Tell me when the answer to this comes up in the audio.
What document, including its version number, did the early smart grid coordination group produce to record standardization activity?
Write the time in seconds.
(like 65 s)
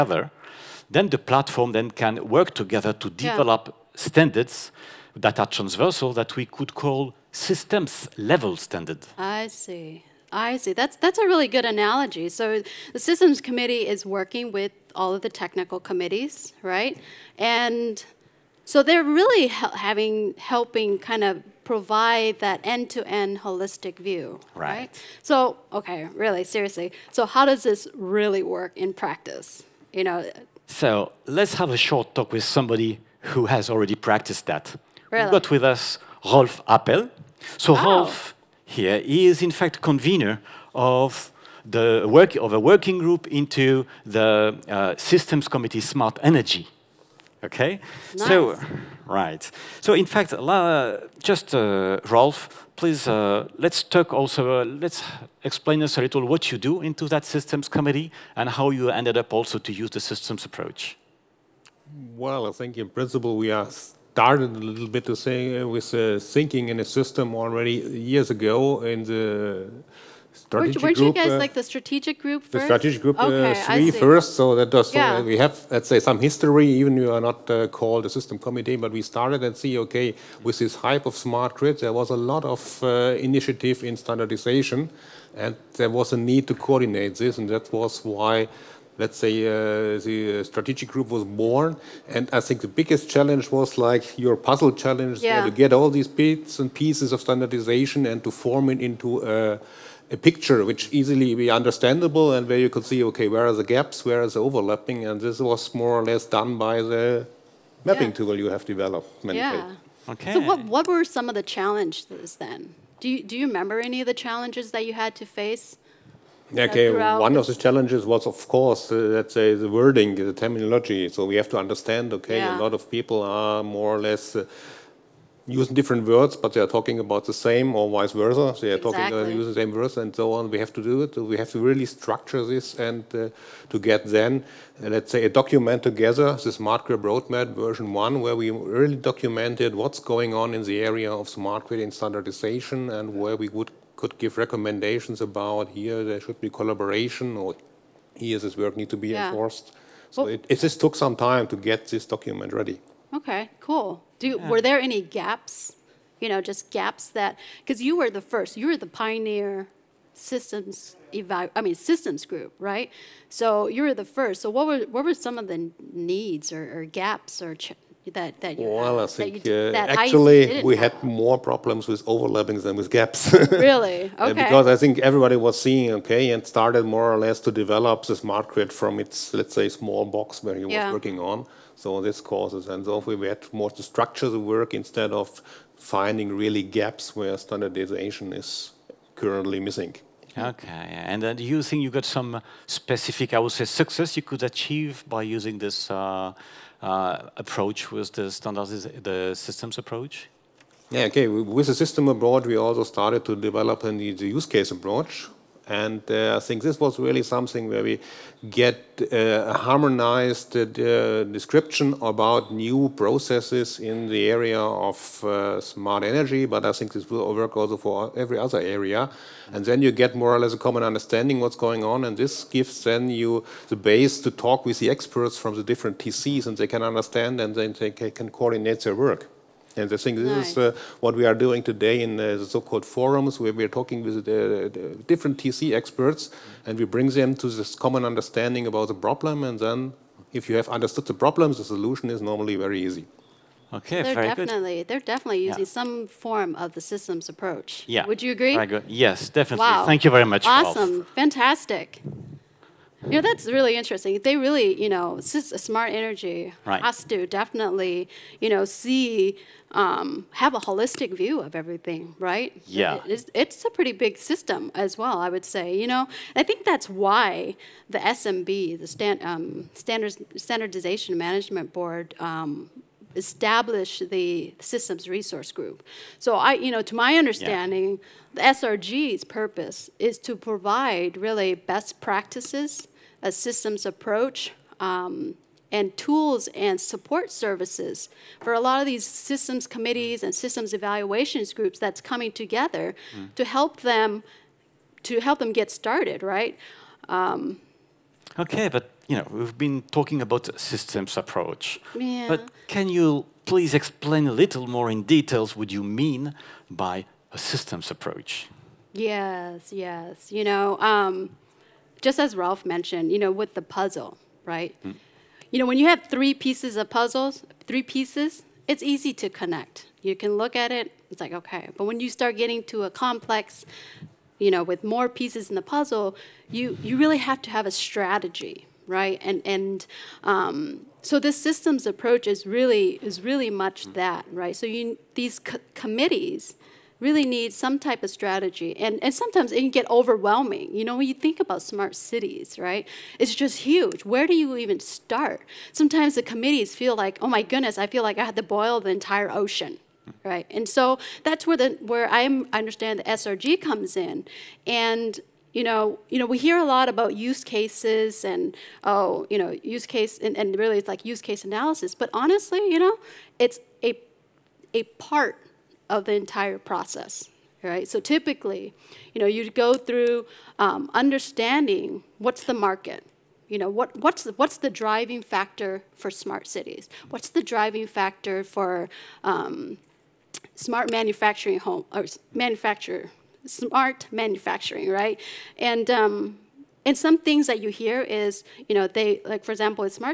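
136 s.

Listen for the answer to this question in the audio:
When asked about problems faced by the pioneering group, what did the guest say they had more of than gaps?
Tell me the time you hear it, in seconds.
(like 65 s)
172 s.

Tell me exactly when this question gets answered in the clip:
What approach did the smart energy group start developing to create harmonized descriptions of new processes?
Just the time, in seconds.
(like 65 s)
204 s.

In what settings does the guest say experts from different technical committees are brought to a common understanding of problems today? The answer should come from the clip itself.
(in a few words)
forums.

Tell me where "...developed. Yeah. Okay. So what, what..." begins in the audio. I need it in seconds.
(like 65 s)
108 s.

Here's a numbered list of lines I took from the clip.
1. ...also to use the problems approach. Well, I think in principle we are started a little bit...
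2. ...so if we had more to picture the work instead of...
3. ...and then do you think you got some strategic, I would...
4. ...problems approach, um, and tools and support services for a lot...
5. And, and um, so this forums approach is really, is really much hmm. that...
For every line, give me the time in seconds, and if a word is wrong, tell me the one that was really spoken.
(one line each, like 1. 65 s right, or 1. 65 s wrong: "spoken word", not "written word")
1. 59 s wrong: "systems", not "problems"
2. 182 s wrong: "structure", not "picture"
3. 191 s wrong: "specific", not "strategic"
4. 283 s wrong: "systems", not "problems"
5. 329 s wrong: "systems", not "forums".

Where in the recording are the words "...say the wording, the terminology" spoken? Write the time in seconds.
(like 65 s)
119 s.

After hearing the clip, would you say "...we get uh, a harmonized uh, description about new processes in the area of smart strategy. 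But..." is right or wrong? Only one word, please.
wrong.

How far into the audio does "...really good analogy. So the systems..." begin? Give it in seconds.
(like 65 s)
11 s.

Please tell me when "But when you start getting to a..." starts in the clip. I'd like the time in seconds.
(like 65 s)
321 s.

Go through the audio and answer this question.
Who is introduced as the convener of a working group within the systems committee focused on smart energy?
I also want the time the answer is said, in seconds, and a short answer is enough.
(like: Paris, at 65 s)
Rolf Appel, at 36 s.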